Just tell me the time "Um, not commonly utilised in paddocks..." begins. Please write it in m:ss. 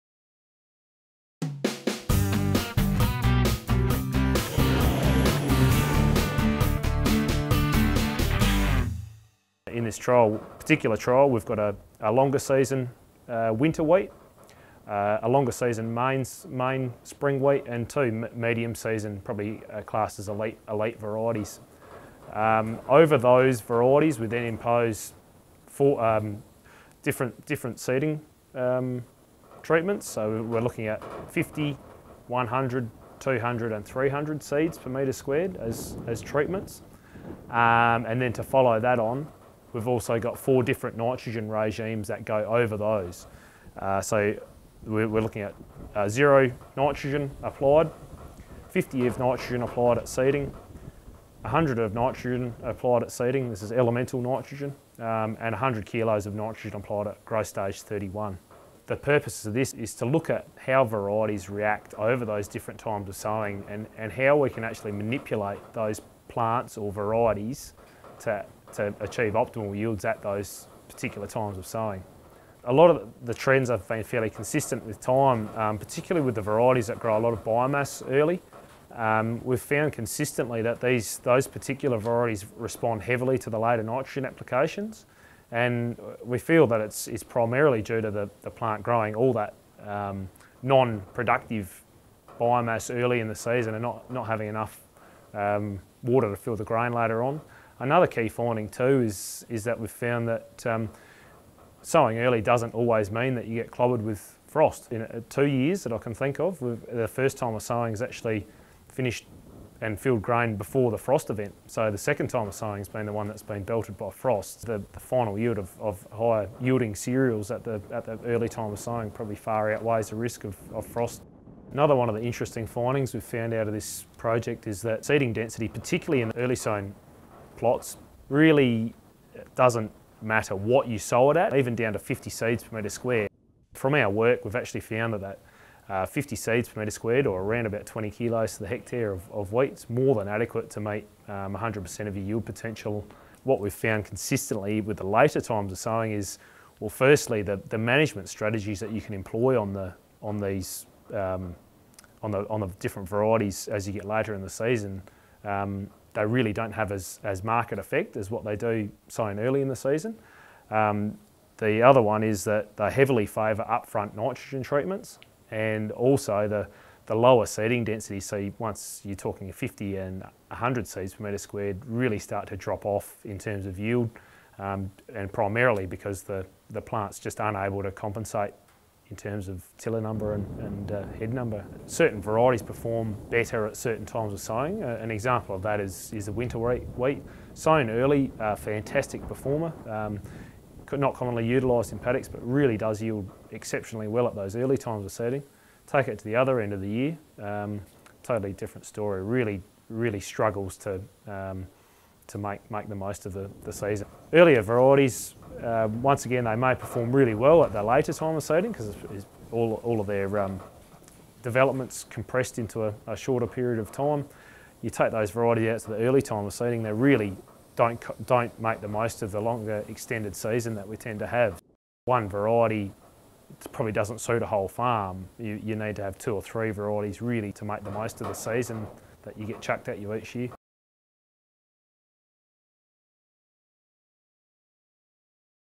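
3:09.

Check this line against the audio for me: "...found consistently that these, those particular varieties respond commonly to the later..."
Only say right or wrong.
wrong.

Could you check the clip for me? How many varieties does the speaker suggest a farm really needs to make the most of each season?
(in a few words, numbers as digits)
2 or 3.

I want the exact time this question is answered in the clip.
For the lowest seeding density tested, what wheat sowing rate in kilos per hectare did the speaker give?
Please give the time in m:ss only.
2:17.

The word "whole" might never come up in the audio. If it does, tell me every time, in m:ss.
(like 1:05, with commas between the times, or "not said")
3:44.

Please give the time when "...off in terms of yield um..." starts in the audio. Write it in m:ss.
2:52.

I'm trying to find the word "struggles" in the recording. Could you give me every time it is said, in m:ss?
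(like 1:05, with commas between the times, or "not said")
3:20.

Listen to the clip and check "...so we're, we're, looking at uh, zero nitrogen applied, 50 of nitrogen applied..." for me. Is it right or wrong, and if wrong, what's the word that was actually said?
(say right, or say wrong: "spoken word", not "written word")
right.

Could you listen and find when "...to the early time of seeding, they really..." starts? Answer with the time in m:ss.
3:35.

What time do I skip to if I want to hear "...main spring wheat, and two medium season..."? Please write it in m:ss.
0:16.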